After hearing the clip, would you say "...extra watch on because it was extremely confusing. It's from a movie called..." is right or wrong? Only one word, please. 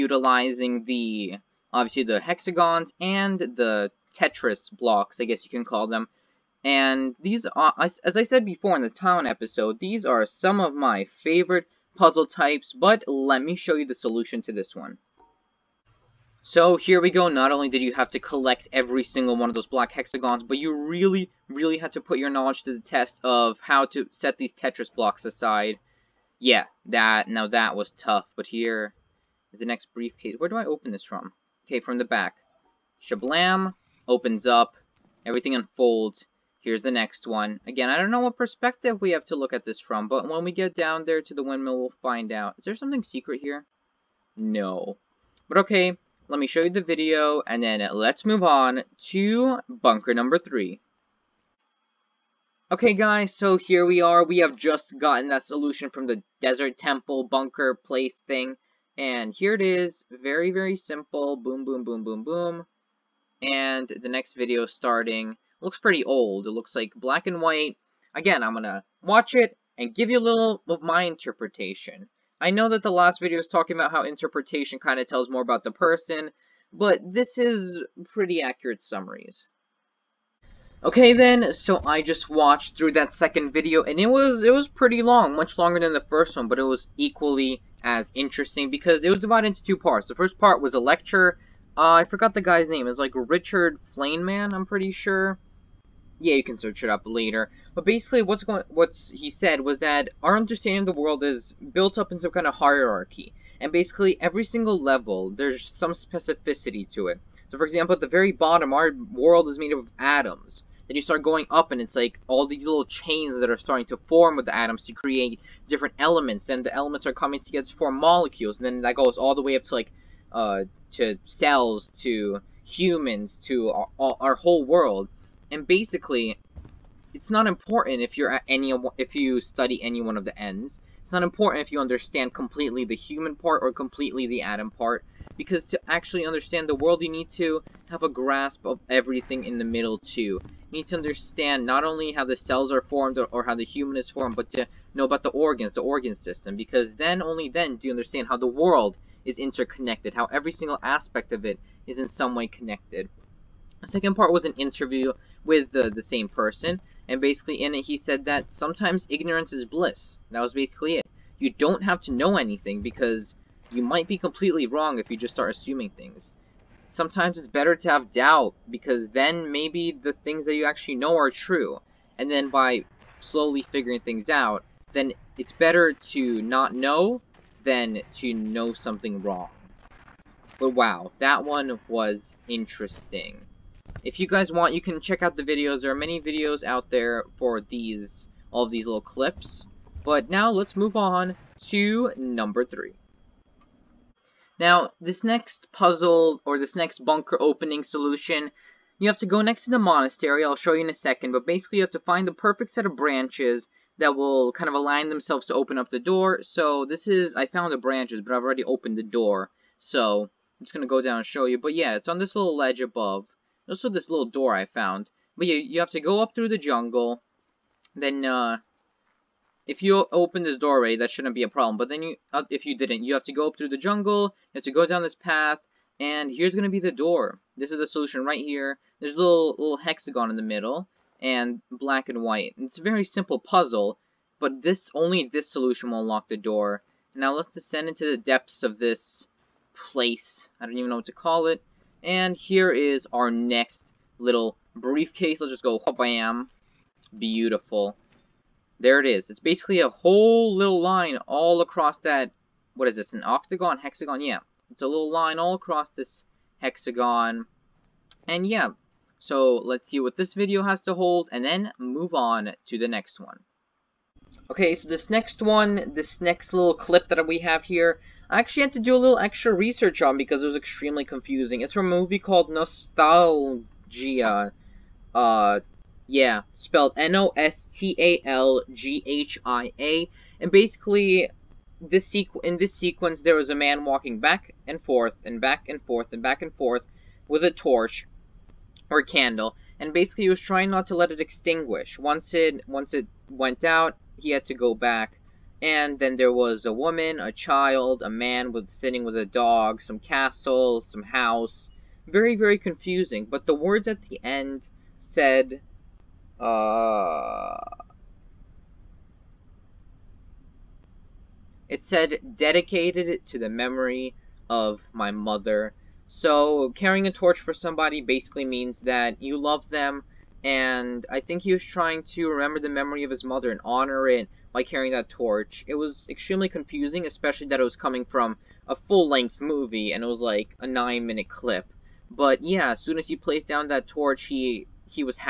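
wrong.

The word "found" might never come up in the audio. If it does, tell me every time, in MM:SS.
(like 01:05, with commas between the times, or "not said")
03:27, 03:34.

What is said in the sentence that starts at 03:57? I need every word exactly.
Now let's descend into the depths of this place.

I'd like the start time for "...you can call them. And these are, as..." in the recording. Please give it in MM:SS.
00:05.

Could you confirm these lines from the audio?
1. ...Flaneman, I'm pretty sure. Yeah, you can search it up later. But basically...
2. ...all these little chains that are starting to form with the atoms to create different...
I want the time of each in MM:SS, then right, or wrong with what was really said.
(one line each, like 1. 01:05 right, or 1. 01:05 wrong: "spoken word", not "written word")
1. 01:33 right
2. 01:52 right.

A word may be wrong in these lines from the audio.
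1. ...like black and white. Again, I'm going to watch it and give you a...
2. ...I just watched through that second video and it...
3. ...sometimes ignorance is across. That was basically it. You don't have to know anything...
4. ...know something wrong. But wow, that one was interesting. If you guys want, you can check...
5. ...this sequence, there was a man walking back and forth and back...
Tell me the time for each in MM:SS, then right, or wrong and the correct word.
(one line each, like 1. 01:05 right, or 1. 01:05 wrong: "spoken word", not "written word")
1. 01:06 right
2. 01:21 right
3. 02:38 wrong: "bliss", not "across"
4. 02:58 right
5. 04:42 right.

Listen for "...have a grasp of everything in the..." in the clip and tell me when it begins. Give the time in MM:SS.
02:17.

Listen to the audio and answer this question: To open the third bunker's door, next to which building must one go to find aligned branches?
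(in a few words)
The monastery.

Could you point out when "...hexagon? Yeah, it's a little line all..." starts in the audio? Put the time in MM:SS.
04:13.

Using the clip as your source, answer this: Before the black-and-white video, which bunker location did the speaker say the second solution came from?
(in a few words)
Desert temple.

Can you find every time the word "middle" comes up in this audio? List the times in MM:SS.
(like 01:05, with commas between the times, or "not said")
02:19, 03:50.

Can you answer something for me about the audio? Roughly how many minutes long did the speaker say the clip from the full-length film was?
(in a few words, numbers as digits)
9.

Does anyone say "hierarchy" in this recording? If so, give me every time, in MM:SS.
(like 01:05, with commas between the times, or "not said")
01:42.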